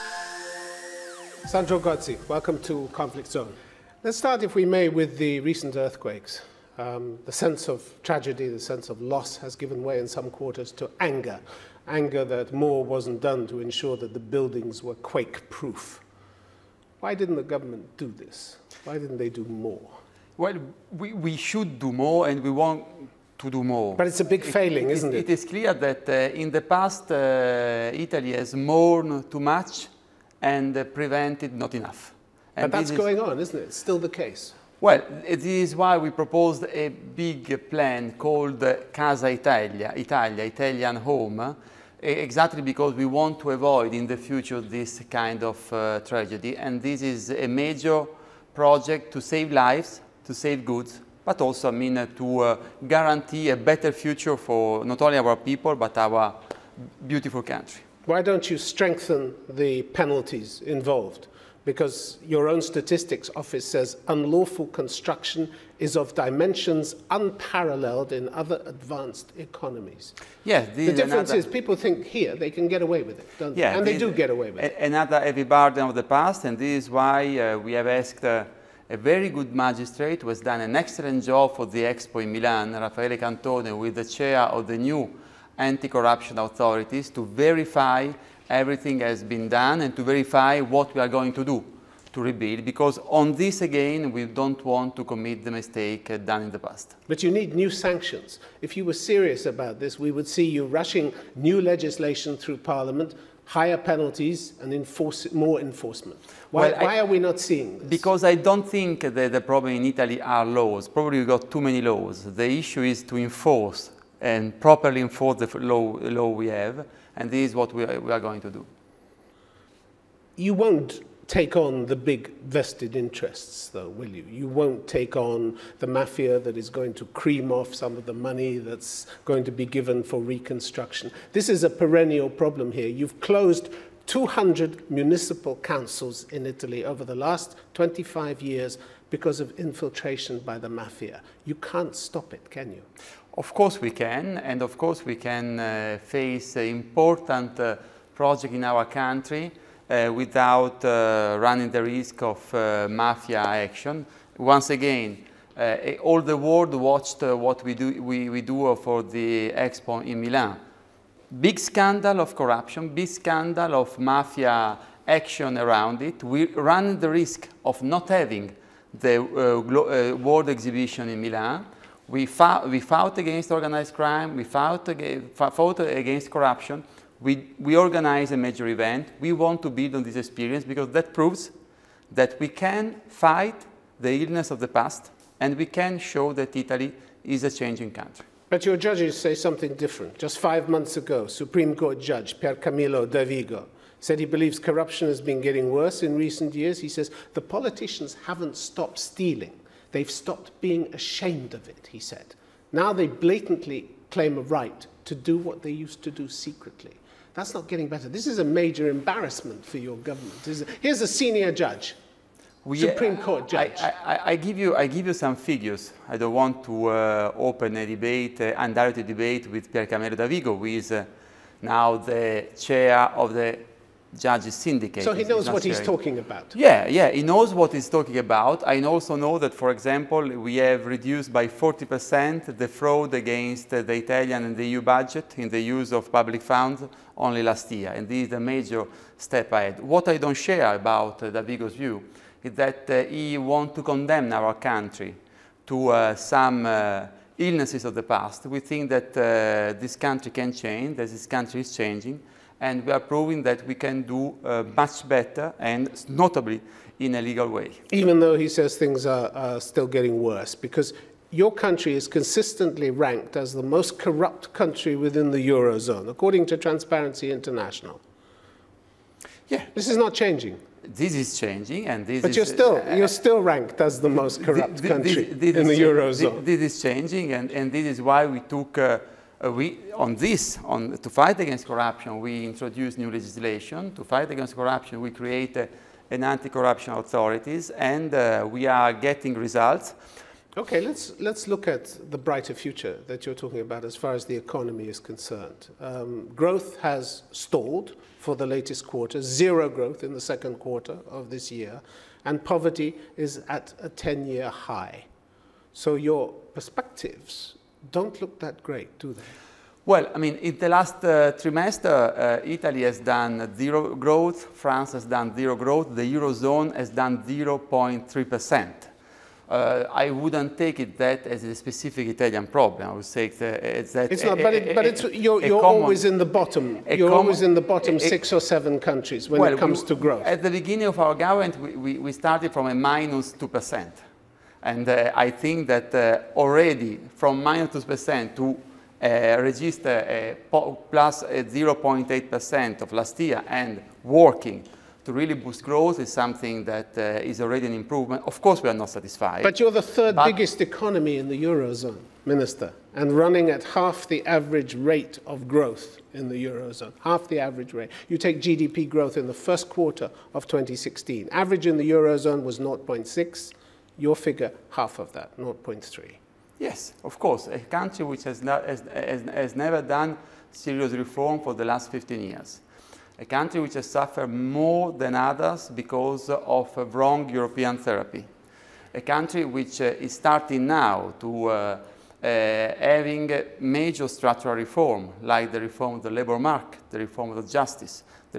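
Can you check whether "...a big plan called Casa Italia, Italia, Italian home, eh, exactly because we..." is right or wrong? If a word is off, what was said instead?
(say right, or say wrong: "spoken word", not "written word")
right.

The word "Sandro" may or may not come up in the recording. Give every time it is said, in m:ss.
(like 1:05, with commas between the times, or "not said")
0:01.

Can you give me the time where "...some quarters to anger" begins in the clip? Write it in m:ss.
0:10.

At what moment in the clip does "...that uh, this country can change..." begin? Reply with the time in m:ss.
4:08.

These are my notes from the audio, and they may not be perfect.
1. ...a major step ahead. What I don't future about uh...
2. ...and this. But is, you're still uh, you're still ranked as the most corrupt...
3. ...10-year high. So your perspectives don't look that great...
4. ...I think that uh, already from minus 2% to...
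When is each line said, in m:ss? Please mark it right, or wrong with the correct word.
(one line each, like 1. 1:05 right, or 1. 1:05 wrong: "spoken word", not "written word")
1. 3:58 wrong: "share", not "future"
2. 4:31 right
3. 5:03 right
4. 5:35 right.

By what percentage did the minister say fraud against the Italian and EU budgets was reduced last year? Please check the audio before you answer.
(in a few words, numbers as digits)
40%.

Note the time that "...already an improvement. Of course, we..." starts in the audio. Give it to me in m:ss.
5:47.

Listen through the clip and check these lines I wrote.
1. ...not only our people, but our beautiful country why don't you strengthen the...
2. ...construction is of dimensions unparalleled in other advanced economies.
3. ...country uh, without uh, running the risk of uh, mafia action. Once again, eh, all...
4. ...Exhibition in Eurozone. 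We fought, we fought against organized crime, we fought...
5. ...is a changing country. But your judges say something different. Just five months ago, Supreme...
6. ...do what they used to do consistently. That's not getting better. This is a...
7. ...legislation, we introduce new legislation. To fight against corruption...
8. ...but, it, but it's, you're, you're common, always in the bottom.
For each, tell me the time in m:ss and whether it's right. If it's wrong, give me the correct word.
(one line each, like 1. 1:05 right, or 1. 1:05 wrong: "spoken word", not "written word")
1. 0:54 right
2. 1:04 right
3. 2:28 right
4. 2:50 wrong: "Milan", not "Eurozone"
5. 3:07 right
6. 3:25 wrong: "secretly", not "consistently"
7. 4:41 wrong: "corruption", not "legislation"
8. 5:24 right.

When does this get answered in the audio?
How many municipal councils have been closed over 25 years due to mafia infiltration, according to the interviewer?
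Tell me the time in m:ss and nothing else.
2:14.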